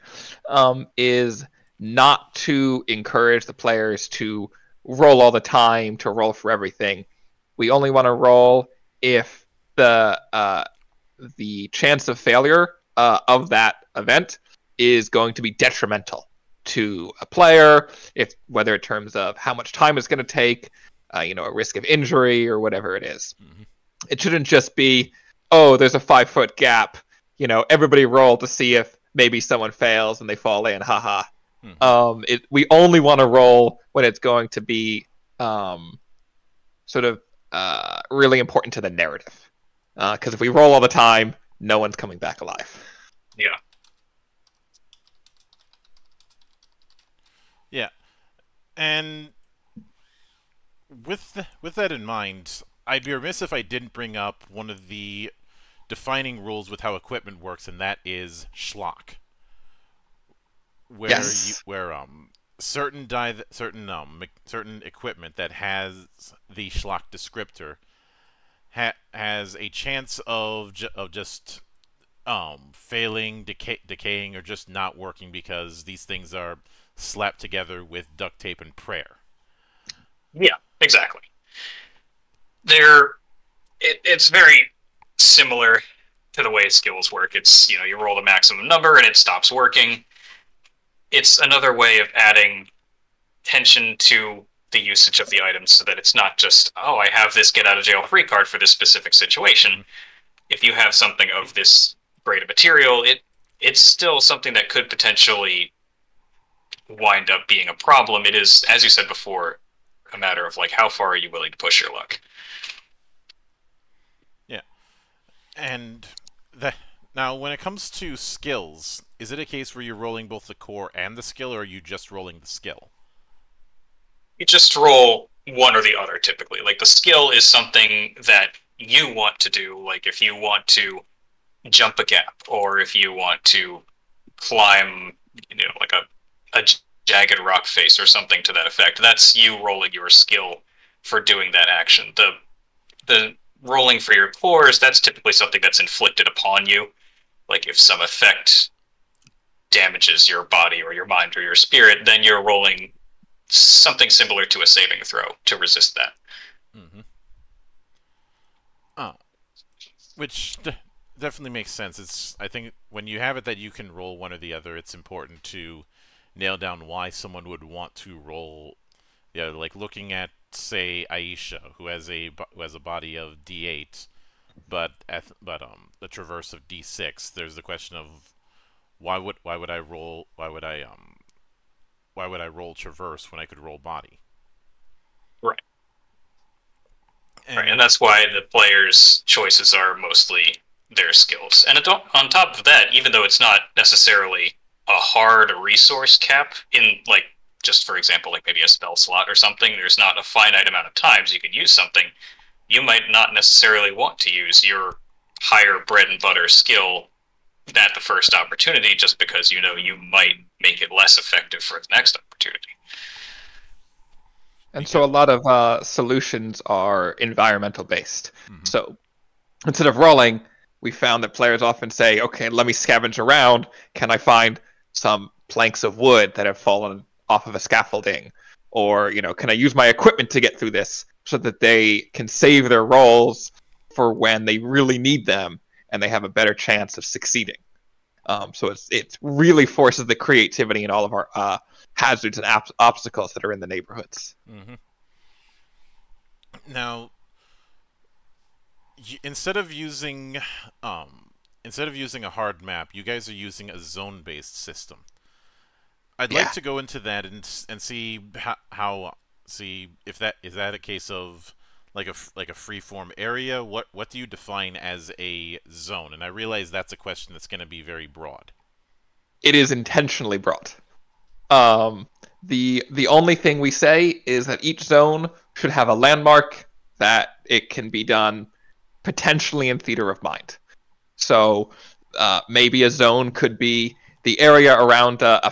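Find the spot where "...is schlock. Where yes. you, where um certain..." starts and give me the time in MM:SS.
00:58.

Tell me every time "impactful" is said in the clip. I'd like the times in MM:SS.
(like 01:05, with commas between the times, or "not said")
not said.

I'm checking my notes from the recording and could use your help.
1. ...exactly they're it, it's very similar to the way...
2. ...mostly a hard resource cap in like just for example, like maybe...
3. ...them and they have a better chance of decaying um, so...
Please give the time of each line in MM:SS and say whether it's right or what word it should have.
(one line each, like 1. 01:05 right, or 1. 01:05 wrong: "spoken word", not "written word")
1. 01:20 right
2. 03:13 wrong: "necessarily", not "mostly"
3. 03:55 wrong: "succeeding", not "decaying".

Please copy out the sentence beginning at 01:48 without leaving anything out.
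It is as you said before a matter of like how far are you willing to push your luck.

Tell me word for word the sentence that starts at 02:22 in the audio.
The the rolling for your cores, that's typically something that's inflicted upon you.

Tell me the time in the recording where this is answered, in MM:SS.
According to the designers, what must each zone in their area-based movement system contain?
04:35.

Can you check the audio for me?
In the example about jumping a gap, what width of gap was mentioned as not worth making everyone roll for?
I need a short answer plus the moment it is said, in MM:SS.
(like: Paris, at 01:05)
5 foot, at 00:25.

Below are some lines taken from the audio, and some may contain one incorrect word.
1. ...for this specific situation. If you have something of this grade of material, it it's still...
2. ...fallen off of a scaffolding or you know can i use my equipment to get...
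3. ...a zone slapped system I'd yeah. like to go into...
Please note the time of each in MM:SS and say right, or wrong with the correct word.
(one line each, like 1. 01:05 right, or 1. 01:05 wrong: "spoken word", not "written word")
1. 01:38 right
2. 03:46 right
3. 04:13 wrong: "based", not "slapped".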